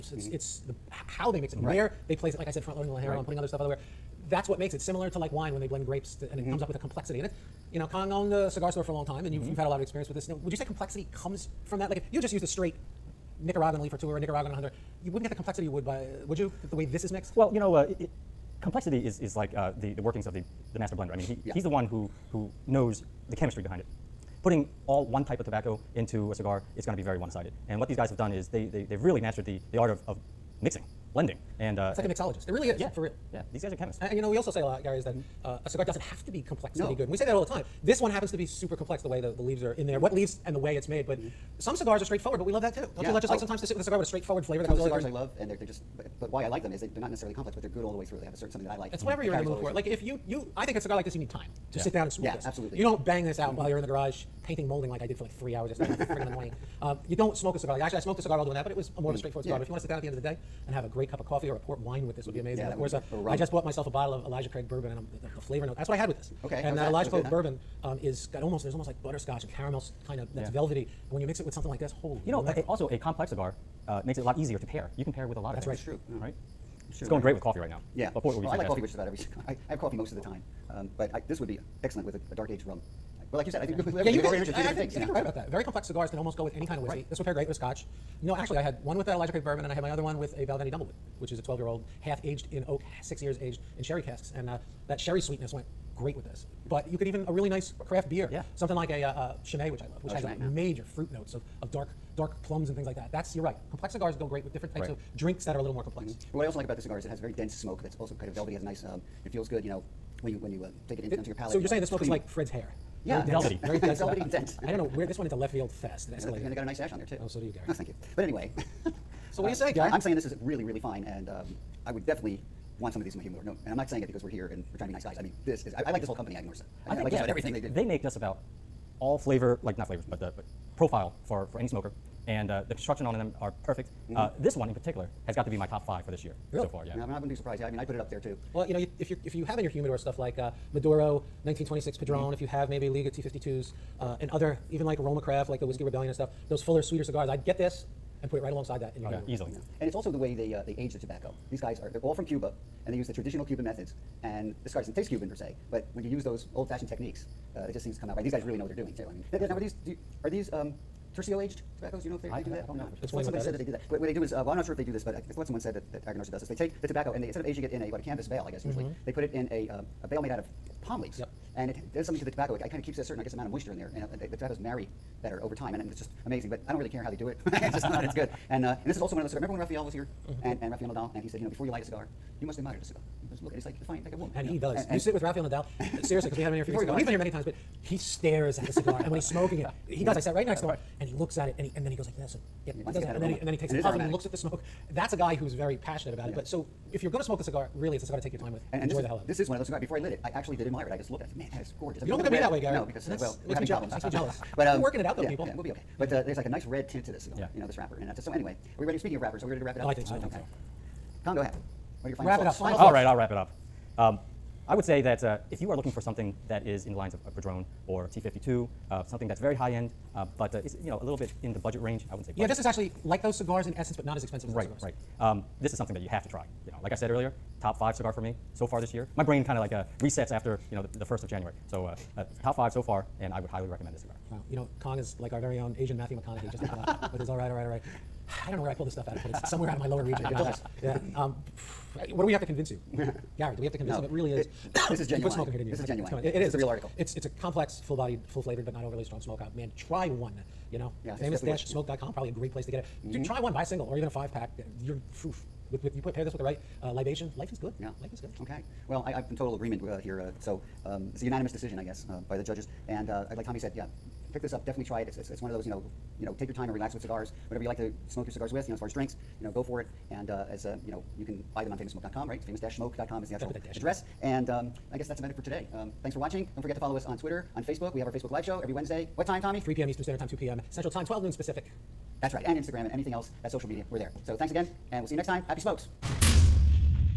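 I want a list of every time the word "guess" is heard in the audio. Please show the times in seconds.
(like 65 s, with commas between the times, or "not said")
168 s, 173 s, 261 s, 274 s.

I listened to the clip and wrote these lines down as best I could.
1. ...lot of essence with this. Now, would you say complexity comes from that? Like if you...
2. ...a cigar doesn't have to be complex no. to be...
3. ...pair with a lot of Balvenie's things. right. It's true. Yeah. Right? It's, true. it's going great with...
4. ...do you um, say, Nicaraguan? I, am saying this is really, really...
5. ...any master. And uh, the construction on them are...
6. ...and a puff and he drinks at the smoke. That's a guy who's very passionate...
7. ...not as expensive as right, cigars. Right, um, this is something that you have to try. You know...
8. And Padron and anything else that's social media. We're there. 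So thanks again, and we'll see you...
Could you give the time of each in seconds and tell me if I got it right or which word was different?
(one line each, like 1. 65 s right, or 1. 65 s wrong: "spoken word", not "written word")
1. 9 s wrong: "experience", not "essence"
2. 35 s right
3. 75 s wrong: "That", not "Balvenie"
4. 119 s wrong: "Guy", not "Nicaraguan"
5. 131 s wrong: "smoker", not "master"
6. 193 s wrong: "looks", not "drinks"
7. 224 s right
8. 282 s wrong: "Instagram", not "Padron".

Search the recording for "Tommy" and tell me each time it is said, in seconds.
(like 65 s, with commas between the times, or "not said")
263 s, 279 s.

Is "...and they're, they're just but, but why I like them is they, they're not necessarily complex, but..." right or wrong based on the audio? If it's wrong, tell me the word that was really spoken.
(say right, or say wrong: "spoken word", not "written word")
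right.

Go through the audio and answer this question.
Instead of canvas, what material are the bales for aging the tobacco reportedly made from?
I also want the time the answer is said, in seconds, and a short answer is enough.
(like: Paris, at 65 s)
palm leaves, at 170 s.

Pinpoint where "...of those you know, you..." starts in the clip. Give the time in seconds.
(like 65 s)
265 s.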